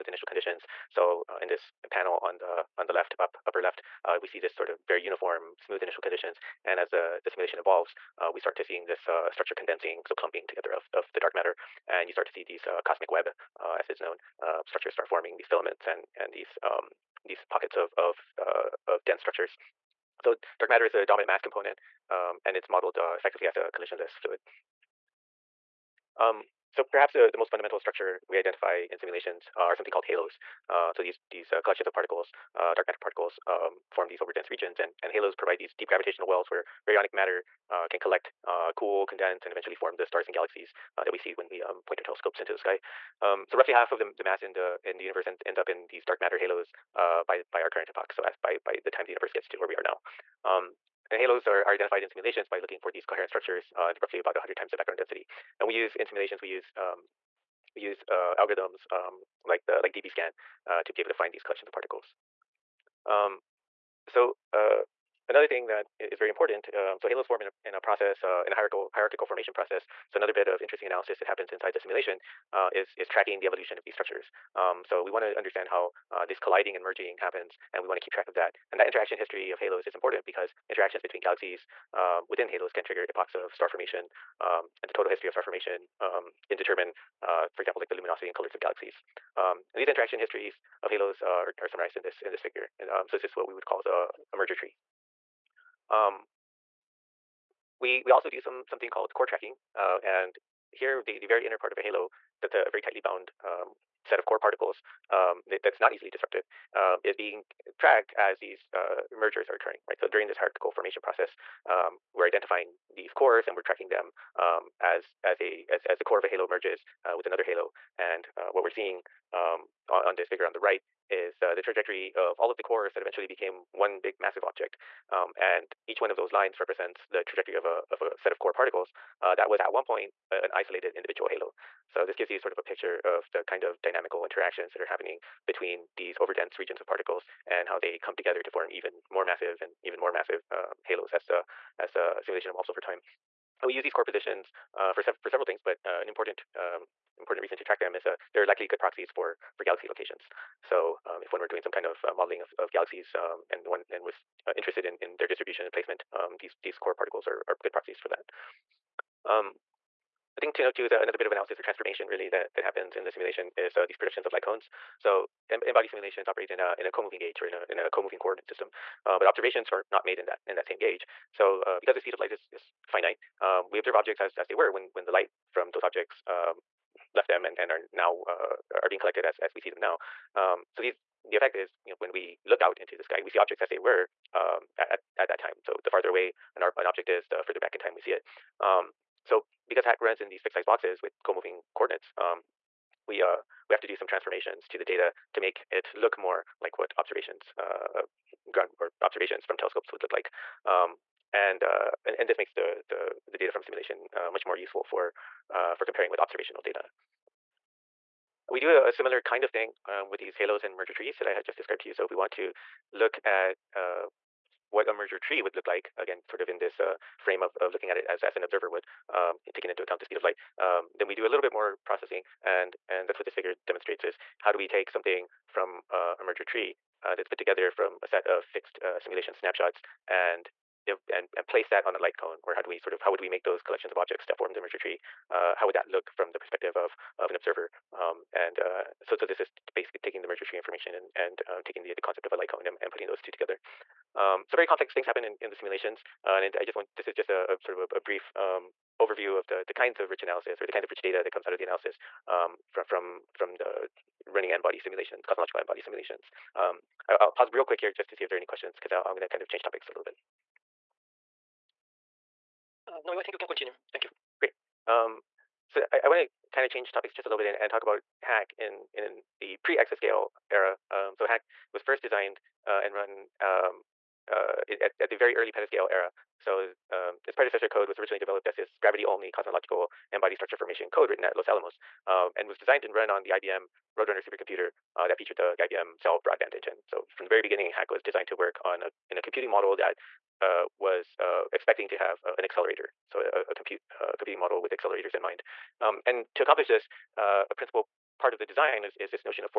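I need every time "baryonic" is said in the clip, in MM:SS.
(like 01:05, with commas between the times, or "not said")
00:36.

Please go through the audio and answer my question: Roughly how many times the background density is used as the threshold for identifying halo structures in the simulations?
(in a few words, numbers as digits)
100.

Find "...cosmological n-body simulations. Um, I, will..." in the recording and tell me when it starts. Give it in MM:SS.
04:15.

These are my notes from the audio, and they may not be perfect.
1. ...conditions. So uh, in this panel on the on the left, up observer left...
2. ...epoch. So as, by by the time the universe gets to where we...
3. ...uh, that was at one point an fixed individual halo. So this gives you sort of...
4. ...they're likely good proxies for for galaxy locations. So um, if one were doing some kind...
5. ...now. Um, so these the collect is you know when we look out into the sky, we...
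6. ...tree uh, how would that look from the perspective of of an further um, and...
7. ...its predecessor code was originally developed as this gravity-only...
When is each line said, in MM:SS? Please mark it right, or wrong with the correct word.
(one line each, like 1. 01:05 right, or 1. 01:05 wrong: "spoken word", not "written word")
1. 00:00 wrong: "upper", not "observer"
2. 00:47 right
3. 02:09 wrong: "isolated", not "fixed"
4. 02:28 right
5. 02:59 wrong: "effect", not "collect"
6. 03:54 wrong: "observer", not "further"
7. 04:37 right.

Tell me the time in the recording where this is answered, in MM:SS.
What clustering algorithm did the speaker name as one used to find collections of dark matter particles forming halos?
00:59.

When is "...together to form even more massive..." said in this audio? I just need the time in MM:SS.
02:18.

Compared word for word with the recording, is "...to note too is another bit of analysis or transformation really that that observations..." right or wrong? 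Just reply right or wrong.
wrong.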